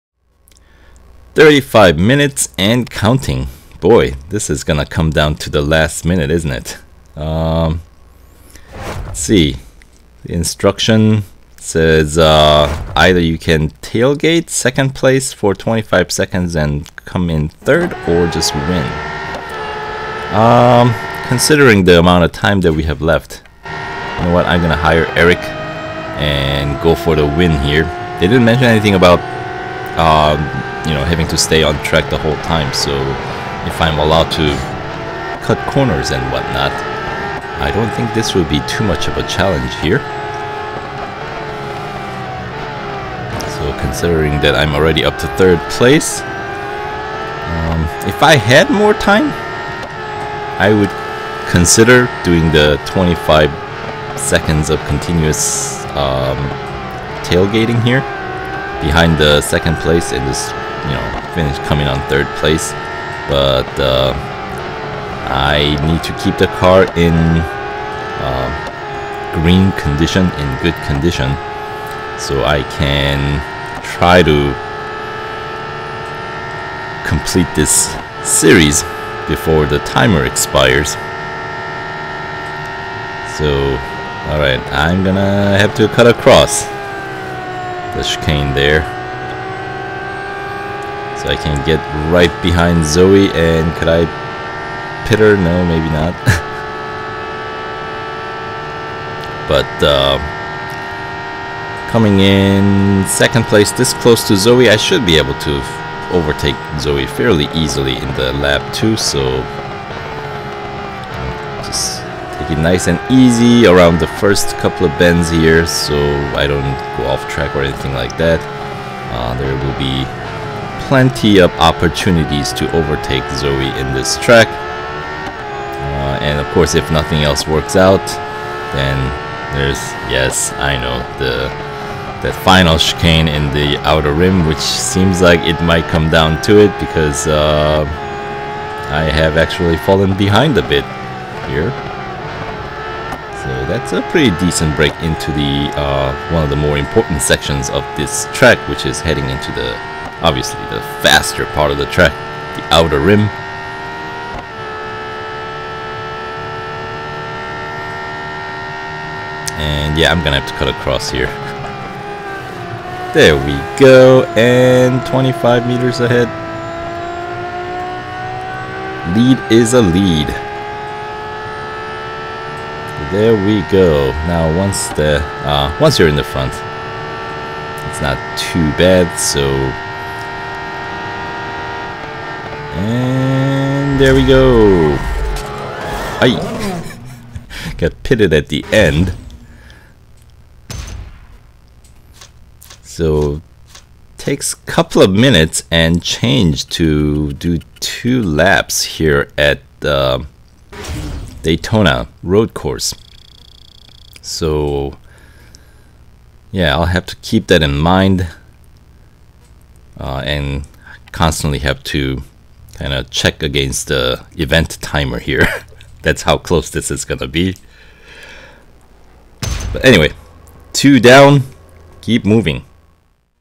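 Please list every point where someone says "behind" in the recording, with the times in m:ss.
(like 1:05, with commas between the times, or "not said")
0:58, 1:32, 2:20.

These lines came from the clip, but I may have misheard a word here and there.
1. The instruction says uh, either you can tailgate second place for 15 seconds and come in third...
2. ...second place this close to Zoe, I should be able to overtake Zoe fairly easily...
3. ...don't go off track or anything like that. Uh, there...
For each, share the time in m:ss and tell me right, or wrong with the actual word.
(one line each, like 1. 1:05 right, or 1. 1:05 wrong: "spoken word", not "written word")
1. 0:10 wrong: "25", not "15"
2. 1:43 right
3. 1:56 right.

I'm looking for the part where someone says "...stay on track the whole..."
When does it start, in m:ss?
0:31.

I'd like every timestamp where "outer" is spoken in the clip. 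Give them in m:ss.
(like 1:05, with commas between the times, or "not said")
2:13, 2:32.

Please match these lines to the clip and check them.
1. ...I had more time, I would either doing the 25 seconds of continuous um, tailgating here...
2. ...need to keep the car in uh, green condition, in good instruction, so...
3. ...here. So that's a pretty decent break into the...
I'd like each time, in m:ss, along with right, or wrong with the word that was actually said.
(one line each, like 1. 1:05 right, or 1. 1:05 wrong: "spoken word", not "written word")
1. 0:48 wrong: "consider", not "either"
2. 1:05 wrong: "condition", not "instruction"
3. 2:21 right.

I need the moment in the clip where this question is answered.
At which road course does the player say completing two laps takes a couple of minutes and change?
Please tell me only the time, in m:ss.
3:21.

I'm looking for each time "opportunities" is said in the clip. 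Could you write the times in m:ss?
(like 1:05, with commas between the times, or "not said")
2:01.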